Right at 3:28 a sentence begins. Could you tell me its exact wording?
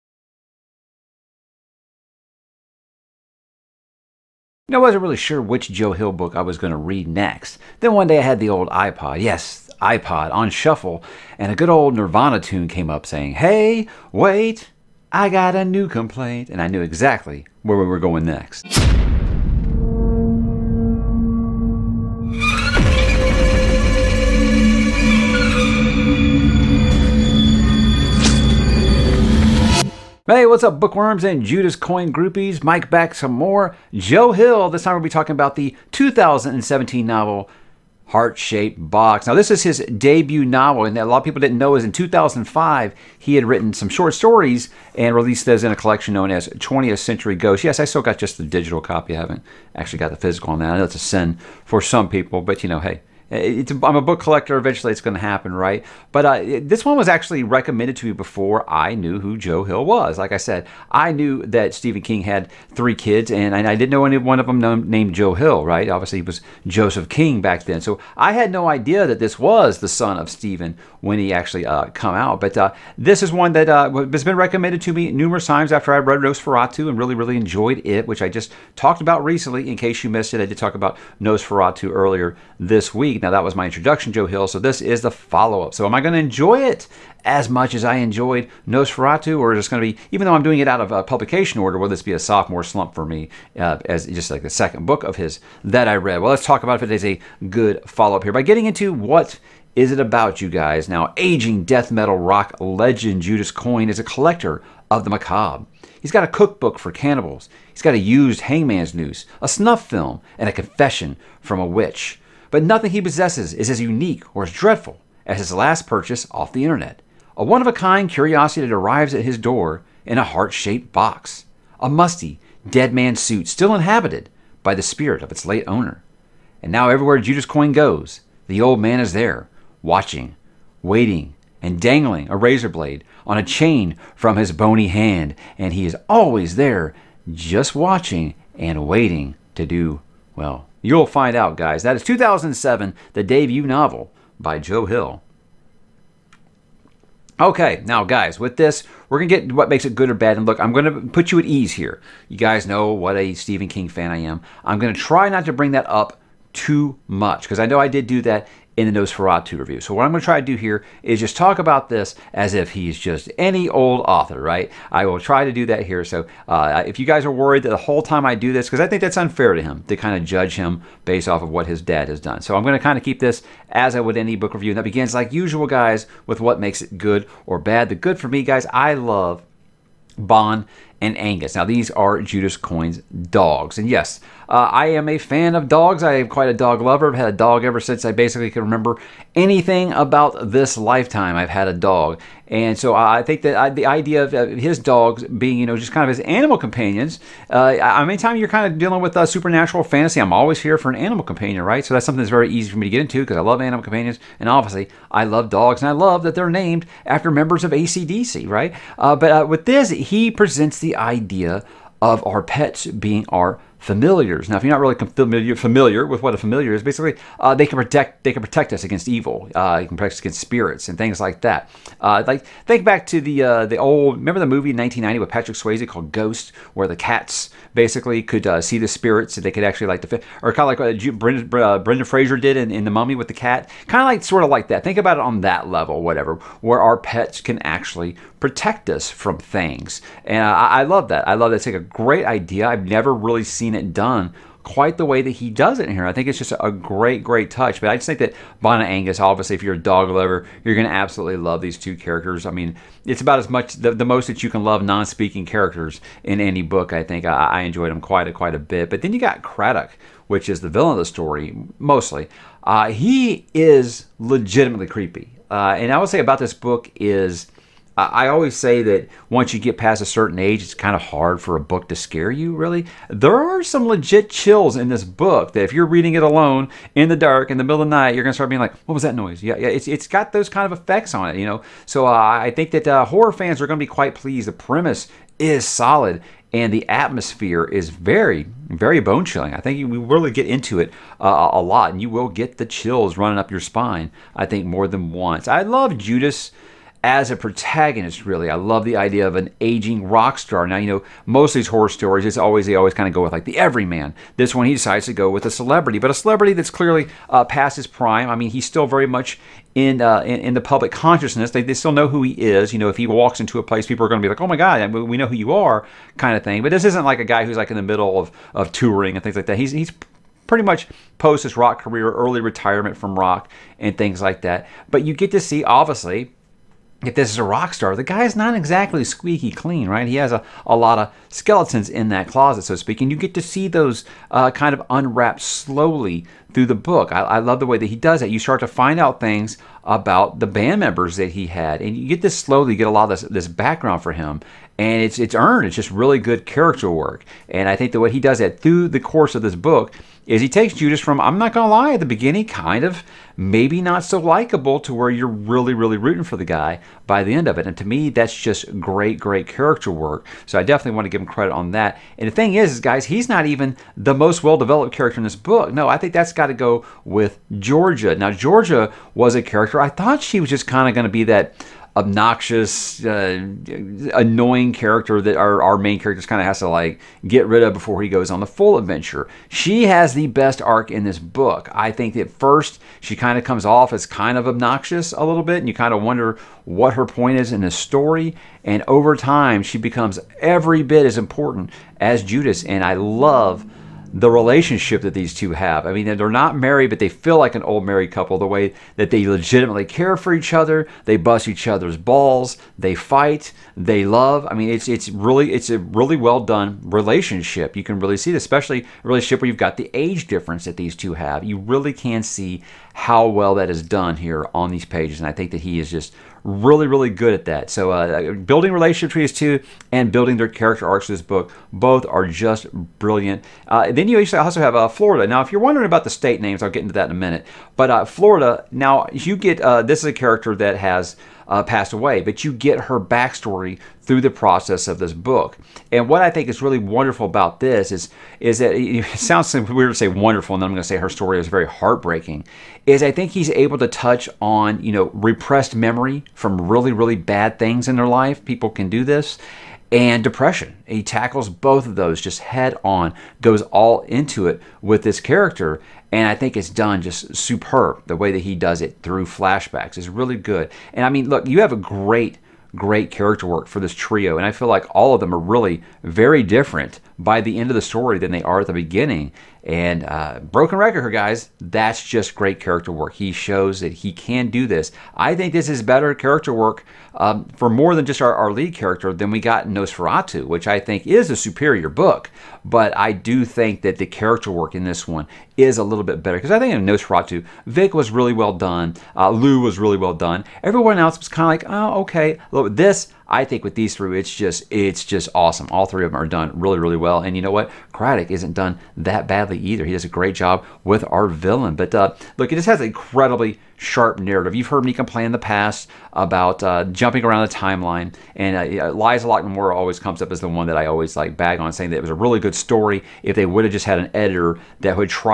Uh, but uh, with this, he presents the idea of our pets being our familiars.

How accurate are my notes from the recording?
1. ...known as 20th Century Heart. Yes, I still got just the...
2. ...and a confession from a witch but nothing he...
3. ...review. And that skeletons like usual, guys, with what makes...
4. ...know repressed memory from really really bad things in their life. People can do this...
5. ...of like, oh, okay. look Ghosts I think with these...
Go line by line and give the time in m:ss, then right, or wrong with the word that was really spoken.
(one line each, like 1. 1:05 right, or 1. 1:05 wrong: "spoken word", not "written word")
1. 0:46 wrong: "Ghosts", not "Heart"
2. 1:50 right
3. 2:54 wrong: "begins", not "skeletons"
4. 7:24 right
5. 8:11 wrong: "This", not "Ghosts".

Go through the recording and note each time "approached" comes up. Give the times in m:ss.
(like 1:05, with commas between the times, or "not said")
not said.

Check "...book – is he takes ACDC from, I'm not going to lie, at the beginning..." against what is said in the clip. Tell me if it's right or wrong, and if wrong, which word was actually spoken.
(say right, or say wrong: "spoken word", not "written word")
wrong: "Judas", not "ACDC".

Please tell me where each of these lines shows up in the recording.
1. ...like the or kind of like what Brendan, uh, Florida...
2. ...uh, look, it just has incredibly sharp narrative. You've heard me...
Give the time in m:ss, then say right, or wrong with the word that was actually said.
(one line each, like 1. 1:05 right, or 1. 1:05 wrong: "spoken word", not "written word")
1. 3:49 wrong: "Brendan", not "Florida"
2. 8:21 right.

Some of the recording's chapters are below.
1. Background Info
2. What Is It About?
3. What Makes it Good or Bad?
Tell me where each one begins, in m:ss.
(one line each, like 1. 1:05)
1. 0:29
2. 1:35
3. 2:54.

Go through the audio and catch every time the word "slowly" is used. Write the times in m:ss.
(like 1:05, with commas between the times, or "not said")
5:35, 5:42.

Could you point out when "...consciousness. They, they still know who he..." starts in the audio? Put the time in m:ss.
5:10.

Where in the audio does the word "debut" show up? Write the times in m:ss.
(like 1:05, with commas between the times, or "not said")
0:39, 2:23.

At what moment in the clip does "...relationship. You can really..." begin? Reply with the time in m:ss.
6:46.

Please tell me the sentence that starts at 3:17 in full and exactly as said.
Uh, I, anytime you're kind of dealing with uh, supernatural fantasy, I'm always here for an animal companion, right?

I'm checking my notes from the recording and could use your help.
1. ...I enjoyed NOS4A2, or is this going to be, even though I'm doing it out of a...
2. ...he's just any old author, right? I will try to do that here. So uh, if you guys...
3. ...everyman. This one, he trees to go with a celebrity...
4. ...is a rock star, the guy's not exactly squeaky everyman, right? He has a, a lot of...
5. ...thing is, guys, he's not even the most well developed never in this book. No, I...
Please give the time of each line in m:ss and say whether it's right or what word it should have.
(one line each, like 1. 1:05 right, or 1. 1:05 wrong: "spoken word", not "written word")
1. 1:27 right
2. 2:42 right
3. 5:03 wrong: "decides", not "trees"
4. 5:27 wrong: "clean", not "everyman"
5. 6:02 wrong: "character", not "never".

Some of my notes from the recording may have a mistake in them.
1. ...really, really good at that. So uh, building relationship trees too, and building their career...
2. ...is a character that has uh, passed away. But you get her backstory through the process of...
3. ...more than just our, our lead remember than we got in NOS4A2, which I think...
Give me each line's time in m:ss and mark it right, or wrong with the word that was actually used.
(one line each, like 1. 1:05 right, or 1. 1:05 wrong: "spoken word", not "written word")
1. 6:56 wrong: "character", not "career"
2. 7:09 right
3. 7:57 wrong: "character", not "remember".